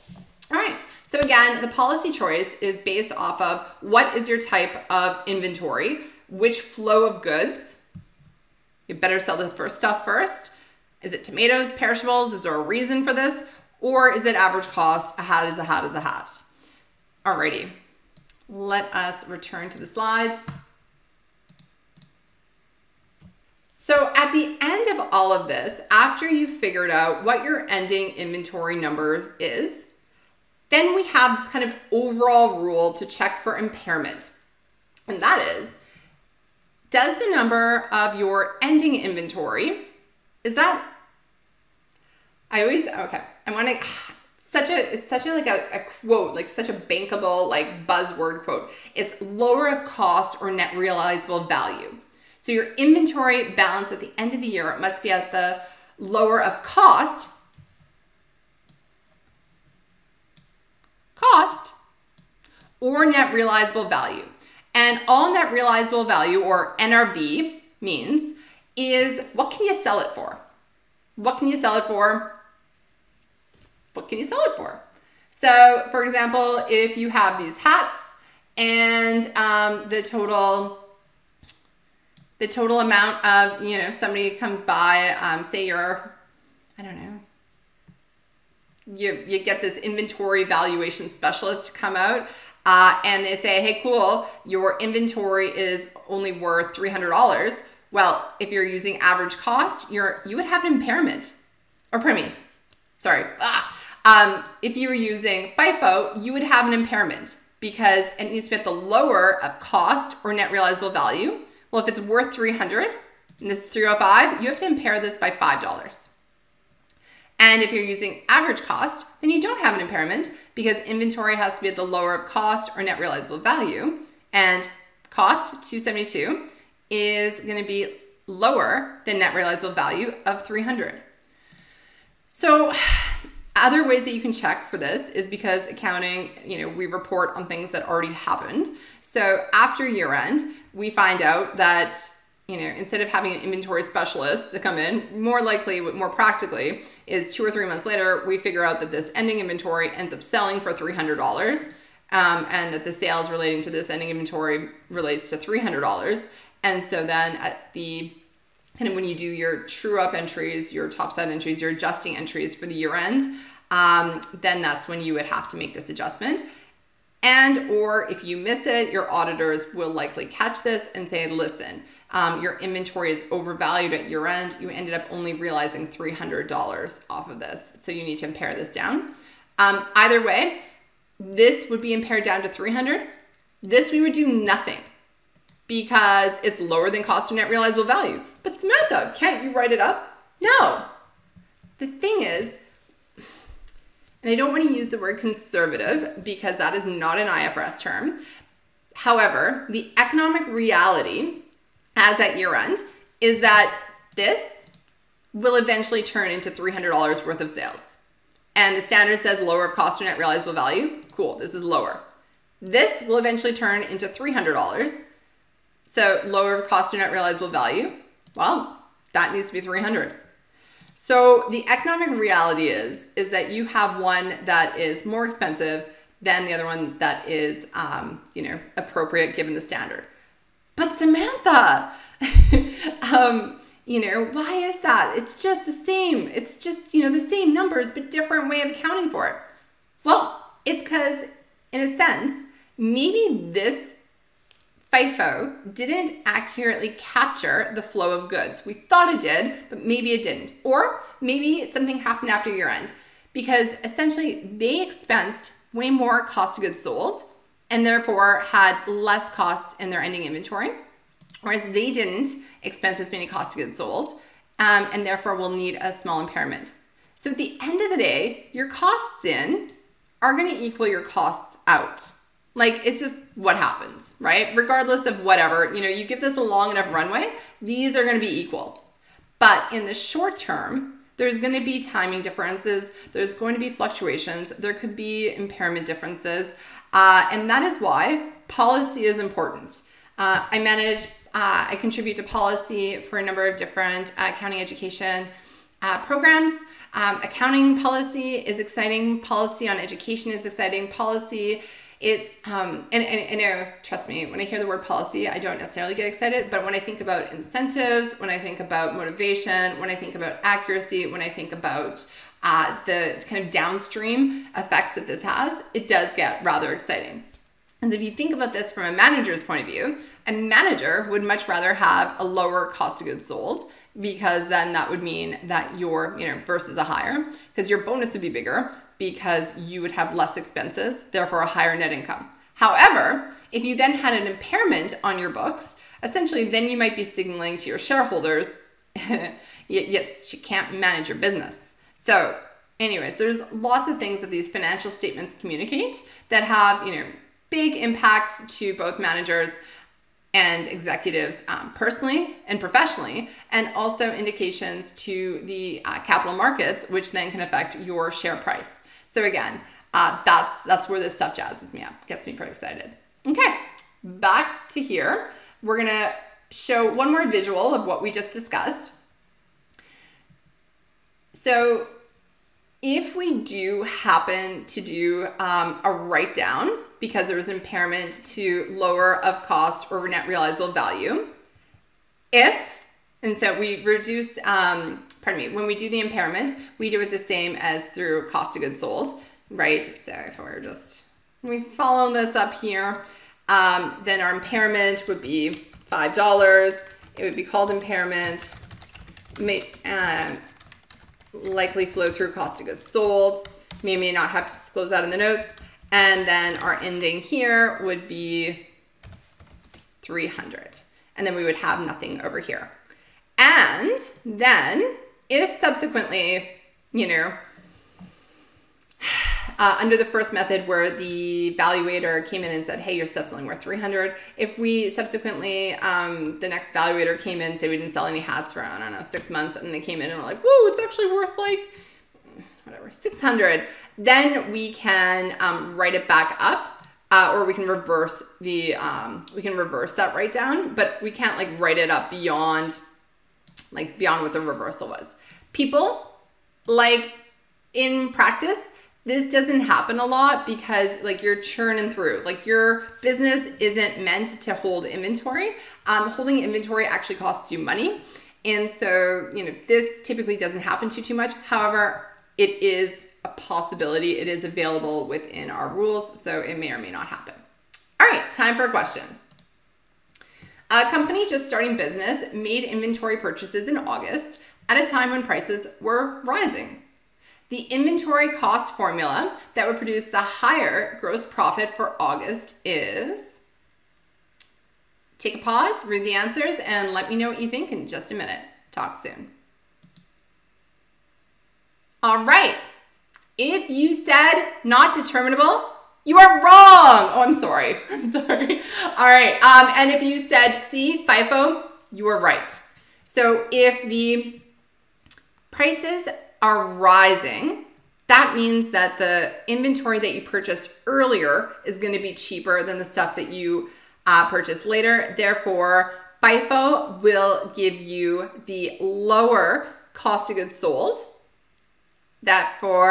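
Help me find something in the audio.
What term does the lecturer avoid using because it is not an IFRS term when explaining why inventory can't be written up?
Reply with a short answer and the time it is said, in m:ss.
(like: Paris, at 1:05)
conservative, at 3:15.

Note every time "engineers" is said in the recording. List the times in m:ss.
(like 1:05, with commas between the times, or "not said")
not said.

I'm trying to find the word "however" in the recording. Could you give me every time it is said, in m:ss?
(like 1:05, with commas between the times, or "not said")
3:18, 5:32, 7:41.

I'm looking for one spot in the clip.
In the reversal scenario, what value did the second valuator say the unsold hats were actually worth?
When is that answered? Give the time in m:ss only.
7:12.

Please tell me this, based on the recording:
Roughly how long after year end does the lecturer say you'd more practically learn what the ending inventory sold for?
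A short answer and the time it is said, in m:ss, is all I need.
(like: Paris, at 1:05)
two or three months, at 2:27.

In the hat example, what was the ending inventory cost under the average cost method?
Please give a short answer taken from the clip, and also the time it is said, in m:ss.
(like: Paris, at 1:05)
272, at 2:05.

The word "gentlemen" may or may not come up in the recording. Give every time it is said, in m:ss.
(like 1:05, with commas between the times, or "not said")
not said.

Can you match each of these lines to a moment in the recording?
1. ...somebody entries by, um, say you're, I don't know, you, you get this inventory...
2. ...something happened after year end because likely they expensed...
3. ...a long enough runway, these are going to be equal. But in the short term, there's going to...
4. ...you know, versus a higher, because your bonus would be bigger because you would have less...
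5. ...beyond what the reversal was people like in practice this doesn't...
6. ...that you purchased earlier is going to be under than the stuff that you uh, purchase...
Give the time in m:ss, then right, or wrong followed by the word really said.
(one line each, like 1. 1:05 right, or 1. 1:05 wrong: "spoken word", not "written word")
1. 1:23 wrong: "comes", not "entries"
2. 4:11 wrong: "essentially", not "likely"
3. 4:36 right
4. 5:26 right
5. 7:23 right
6. 8:29 wrong: "cheaper", not "under".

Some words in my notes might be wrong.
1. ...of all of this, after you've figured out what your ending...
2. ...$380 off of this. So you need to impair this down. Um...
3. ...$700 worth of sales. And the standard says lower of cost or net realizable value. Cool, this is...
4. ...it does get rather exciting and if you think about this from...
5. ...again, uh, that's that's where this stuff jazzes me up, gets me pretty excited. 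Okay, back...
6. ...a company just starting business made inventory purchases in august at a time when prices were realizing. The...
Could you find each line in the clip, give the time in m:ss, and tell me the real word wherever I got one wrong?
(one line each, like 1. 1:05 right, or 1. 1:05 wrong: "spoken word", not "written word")
1. 0:24 right
2. 2:55 wrong: "300", not "380"
3. 3:26 wrong: "300", not "700"
4. 5:15 right
5. 5:59 right
6. 7:50 wrong: "rising", not "realizing".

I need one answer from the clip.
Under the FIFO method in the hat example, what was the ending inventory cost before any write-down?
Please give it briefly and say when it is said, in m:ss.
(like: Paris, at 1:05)
305, at 1:53.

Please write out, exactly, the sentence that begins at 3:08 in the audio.
But Samantha, can't you write it up?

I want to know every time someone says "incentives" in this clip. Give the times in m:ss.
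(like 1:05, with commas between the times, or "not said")
5:07.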